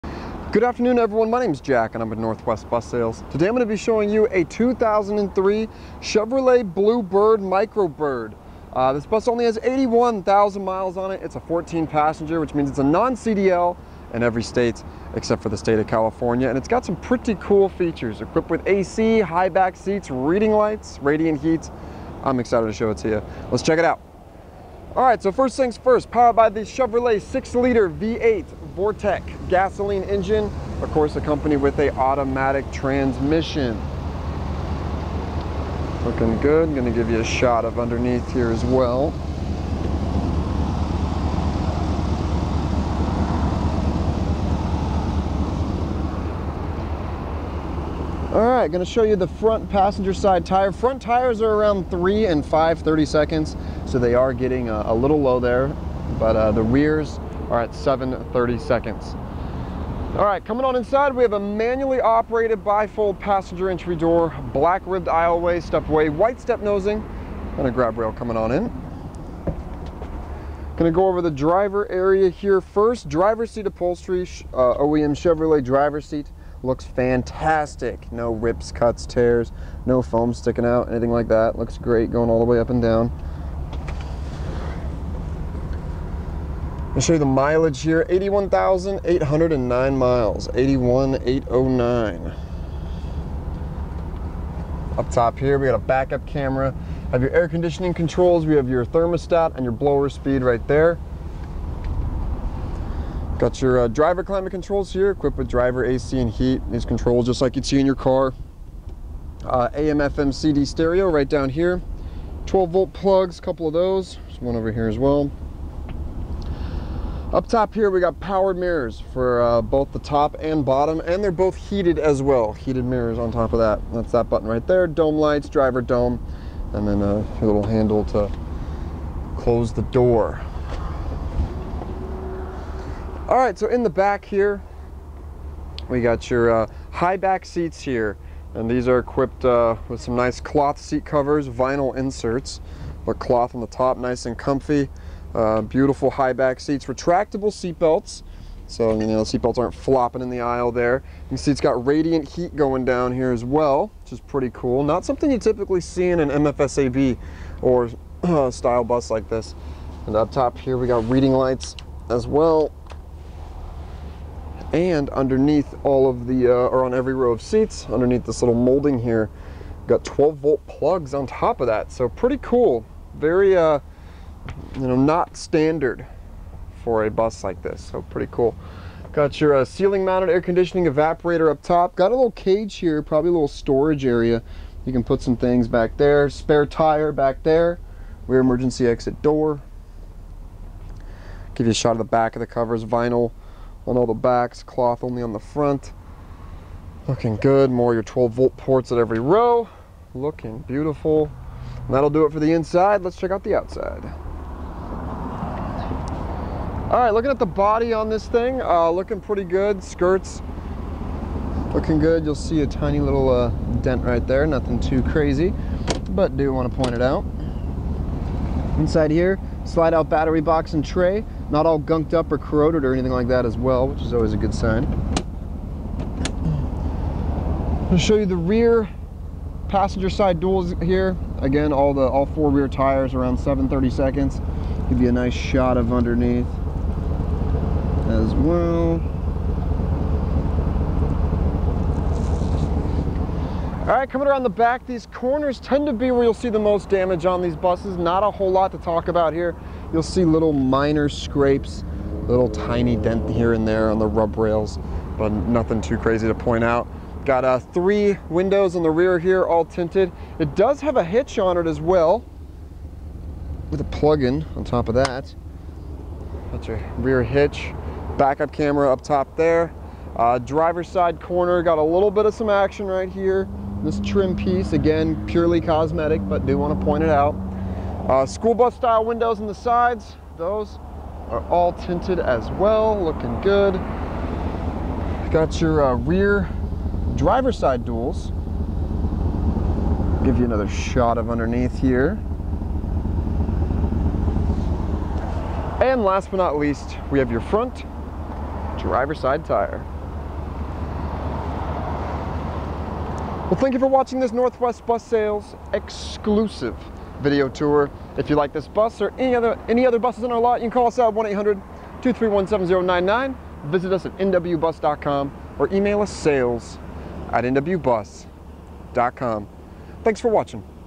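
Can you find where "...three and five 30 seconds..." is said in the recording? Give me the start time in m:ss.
0:51.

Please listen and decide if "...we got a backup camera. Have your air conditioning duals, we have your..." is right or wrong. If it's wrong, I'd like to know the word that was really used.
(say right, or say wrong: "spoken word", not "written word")
wrong: "controls", not "duals".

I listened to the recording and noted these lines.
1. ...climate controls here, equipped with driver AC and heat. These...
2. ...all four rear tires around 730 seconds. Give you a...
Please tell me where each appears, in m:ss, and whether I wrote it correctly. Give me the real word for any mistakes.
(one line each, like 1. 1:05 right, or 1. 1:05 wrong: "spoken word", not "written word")
1. 1:44 right
2. 3:52 right.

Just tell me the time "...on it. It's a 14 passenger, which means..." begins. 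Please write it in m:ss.
0:10.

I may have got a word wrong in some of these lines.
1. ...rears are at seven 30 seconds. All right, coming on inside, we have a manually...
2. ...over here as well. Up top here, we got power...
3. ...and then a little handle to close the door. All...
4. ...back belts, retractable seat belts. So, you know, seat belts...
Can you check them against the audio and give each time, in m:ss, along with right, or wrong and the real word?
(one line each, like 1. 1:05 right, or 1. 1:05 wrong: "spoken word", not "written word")
1. 0:56 right
2. 1:54 right
3. 2:06 right
4. 2:26 wrong: "seats", not "belts".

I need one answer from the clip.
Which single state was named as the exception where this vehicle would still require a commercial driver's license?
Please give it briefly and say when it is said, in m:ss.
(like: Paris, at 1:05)
California, at 0:15.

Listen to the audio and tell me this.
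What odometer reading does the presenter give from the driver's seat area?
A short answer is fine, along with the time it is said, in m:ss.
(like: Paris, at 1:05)
81,809 miles, at 1:28.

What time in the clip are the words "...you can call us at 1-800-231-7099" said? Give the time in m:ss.
5:10.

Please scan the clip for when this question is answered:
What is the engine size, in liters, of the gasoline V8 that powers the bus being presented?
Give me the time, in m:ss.
0:27.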